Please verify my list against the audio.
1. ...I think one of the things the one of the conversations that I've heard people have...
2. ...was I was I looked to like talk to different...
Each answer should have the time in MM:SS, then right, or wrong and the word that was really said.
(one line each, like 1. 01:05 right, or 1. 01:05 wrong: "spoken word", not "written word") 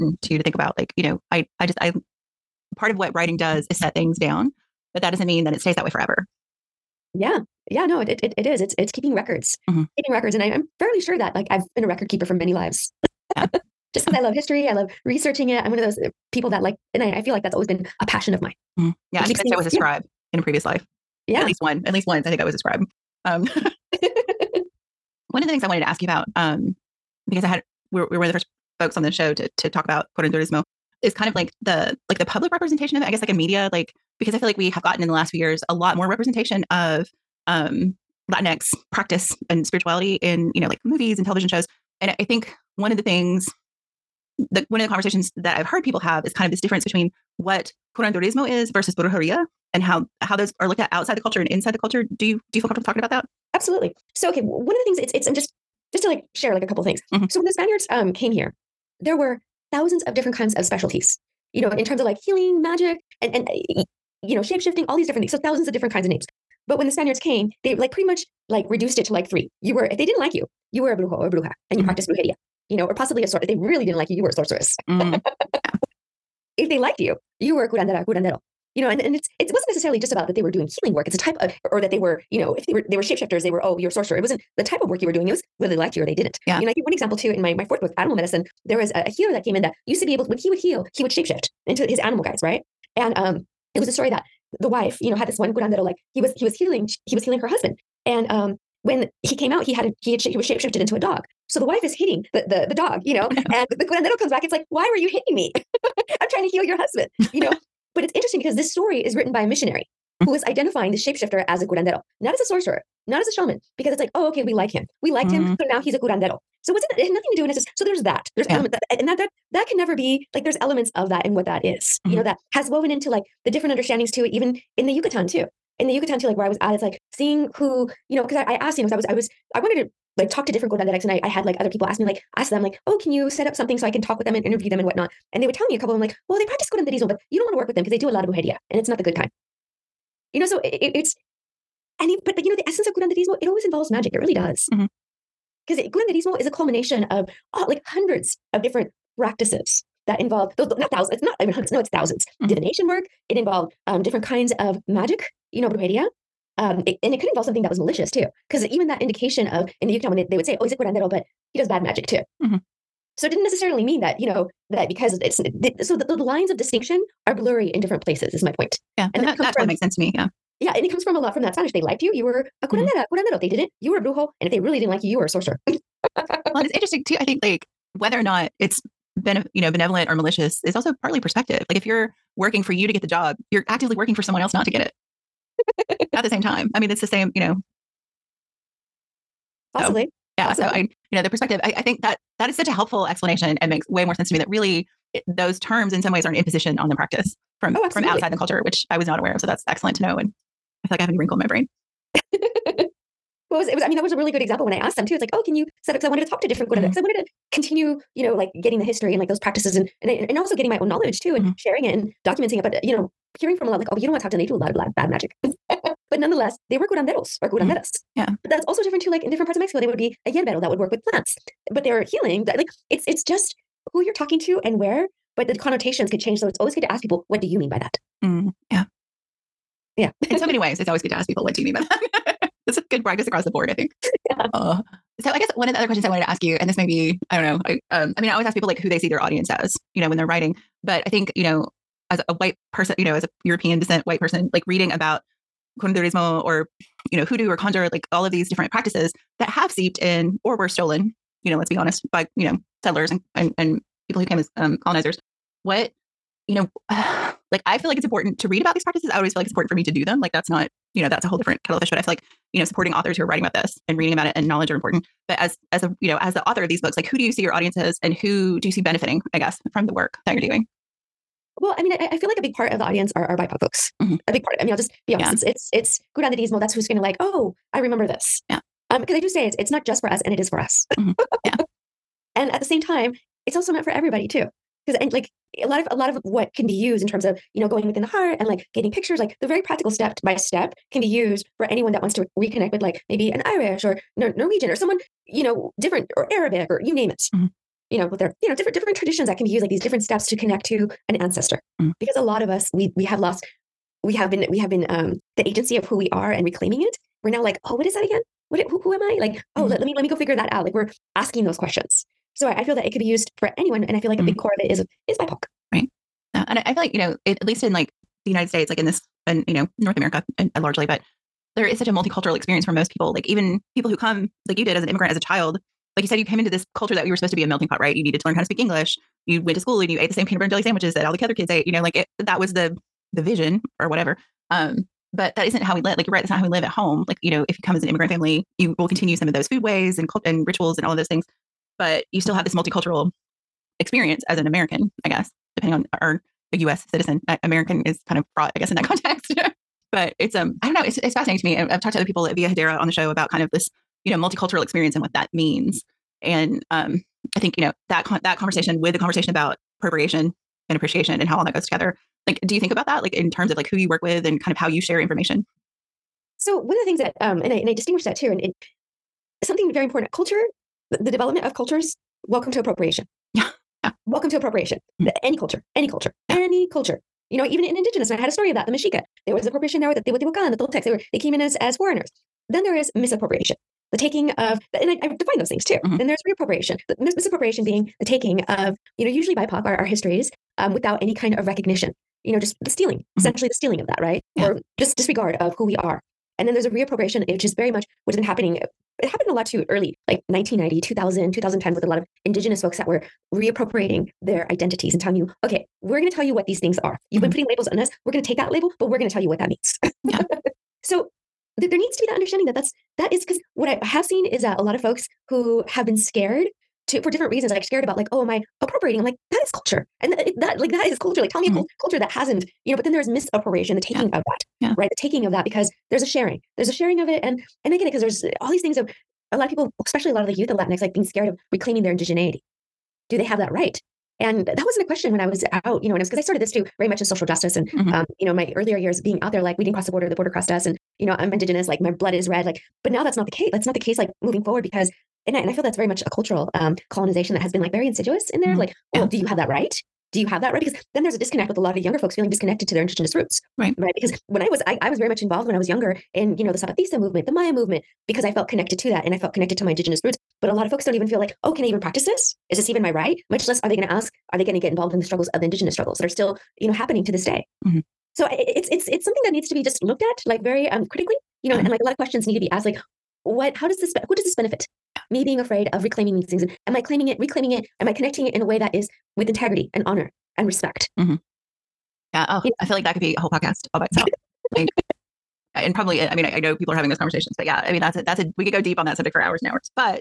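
1. 00:42 right
2. 02:08 wrong: "wanted", not "looked".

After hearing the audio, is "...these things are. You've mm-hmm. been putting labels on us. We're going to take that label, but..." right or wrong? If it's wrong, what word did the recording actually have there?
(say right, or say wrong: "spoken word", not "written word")
right.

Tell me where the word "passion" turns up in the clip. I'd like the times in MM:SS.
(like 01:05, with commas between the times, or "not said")
00:18.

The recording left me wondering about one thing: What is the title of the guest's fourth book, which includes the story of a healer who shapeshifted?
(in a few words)
Animal Medicine.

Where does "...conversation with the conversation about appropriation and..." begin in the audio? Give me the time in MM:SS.
05:58.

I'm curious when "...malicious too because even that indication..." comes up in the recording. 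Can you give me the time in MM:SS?
02:37.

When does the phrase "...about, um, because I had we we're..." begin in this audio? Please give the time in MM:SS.
00:26.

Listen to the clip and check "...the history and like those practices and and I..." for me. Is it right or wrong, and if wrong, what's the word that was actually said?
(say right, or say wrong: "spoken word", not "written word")
right.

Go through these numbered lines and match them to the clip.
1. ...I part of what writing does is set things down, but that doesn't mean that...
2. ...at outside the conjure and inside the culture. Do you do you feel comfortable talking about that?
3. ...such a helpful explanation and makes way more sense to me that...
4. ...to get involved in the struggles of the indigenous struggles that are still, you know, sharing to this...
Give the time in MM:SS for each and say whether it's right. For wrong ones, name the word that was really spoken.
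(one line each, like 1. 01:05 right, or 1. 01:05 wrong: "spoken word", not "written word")
1. 00:01 right
2. 00:50 wrong: "culture", not "conjure"
3. 03:12 right
4. 07:44 wrong: "happening", not "sharing".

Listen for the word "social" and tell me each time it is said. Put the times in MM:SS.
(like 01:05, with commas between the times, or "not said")
07:17.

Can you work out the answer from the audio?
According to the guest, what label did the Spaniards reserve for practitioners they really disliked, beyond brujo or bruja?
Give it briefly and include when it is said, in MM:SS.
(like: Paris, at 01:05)
sorceress, at 01:14.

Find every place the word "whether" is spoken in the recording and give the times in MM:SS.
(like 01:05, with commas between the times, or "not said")
01:25, 02:57.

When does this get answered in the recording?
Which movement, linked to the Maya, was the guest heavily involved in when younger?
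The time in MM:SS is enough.
07:36.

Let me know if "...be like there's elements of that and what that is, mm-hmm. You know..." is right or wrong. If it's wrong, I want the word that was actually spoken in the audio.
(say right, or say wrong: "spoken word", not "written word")
right.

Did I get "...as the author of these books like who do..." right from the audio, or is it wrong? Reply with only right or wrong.
right.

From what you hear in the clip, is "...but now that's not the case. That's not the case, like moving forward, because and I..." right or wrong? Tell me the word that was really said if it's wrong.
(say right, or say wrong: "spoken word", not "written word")
right.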